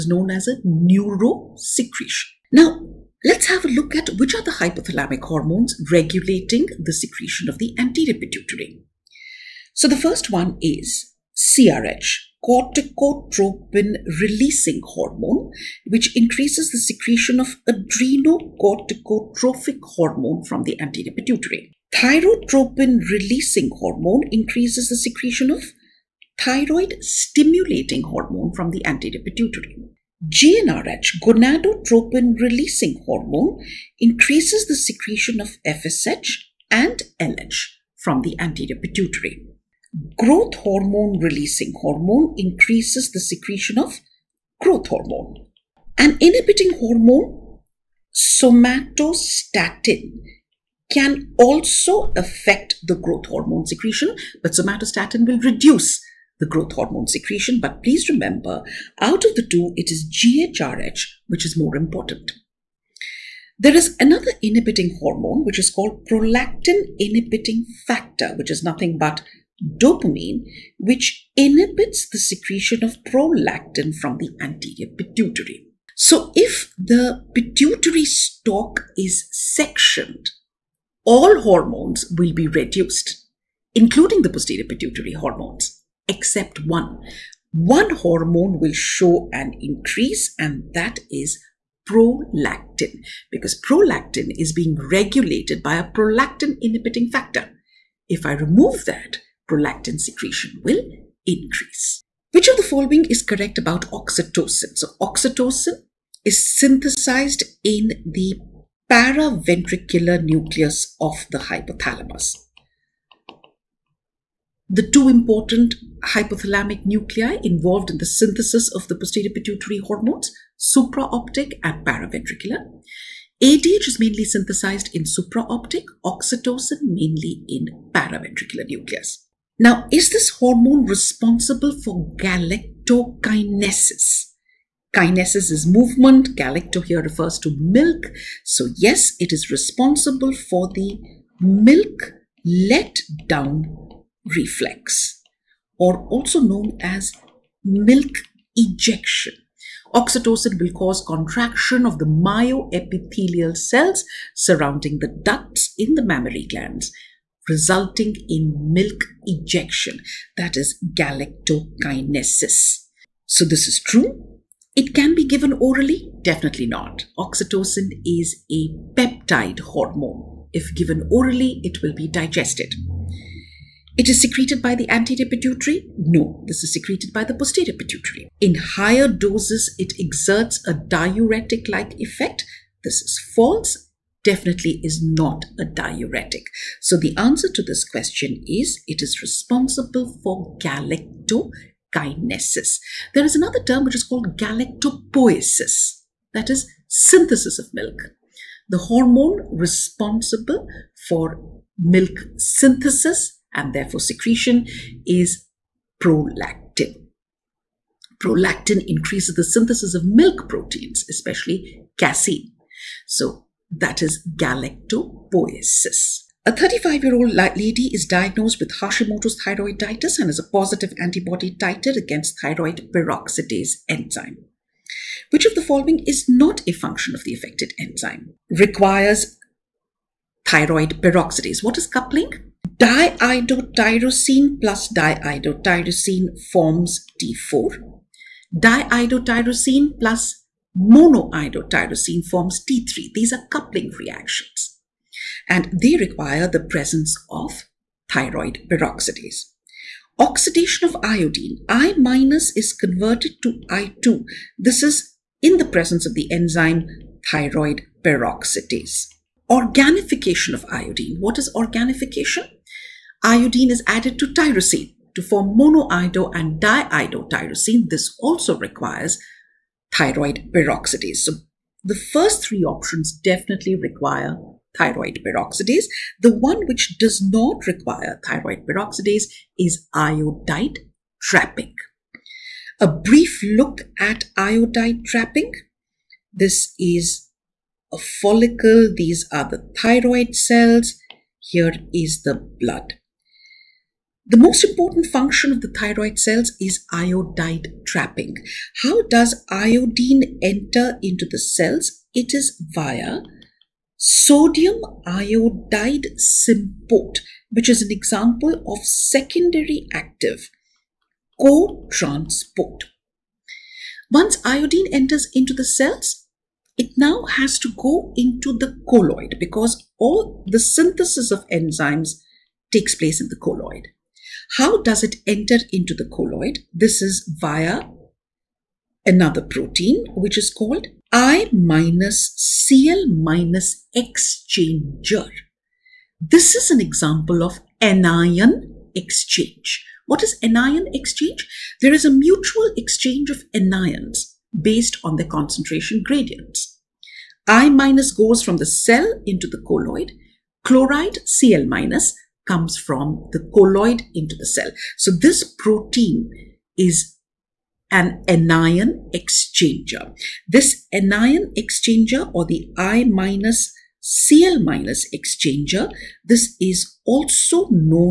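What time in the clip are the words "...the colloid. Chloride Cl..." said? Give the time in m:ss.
5:49.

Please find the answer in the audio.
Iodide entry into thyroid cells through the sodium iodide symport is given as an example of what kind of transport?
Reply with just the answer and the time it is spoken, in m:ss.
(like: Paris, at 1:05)
Secondary active co-transport, at 5:08.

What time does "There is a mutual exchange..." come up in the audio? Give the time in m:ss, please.
5:41.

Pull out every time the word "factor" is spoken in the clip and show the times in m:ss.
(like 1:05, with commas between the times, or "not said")
1:07, 1:37.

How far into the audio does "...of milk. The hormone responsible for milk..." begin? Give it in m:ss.
3:17.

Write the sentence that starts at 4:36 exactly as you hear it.
The one which does not require thyroid peroxidase is iodide trapping.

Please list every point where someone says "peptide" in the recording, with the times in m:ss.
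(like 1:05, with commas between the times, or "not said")
2:48.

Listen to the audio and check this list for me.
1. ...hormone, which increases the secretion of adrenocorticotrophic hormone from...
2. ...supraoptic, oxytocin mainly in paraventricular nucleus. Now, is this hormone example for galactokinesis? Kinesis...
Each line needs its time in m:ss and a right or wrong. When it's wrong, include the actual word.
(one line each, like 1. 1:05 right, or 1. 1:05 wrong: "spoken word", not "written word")
1. 0:14 right
2. 2:05 wrong: "responsible", not "example".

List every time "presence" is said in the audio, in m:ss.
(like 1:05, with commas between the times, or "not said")
4:06, 4:15.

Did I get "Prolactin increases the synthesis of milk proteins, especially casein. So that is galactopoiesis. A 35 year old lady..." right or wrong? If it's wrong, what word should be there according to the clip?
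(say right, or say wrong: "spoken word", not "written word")
right.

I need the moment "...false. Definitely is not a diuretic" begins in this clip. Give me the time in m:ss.
3:03.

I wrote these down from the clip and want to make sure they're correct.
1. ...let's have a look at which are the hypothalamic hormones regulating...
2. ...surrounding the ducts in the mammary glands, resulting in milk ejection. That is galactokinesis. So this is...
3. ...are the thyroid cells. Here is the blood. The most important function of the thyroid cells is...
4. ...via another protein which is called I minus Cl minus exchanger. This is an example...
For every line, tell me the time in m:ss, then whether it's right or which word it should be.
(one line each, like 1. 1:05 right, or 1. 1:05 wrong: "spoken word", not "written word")
1. 0:03 right
2. 2:34 right
3. 4:49 right
4. 5:27 right.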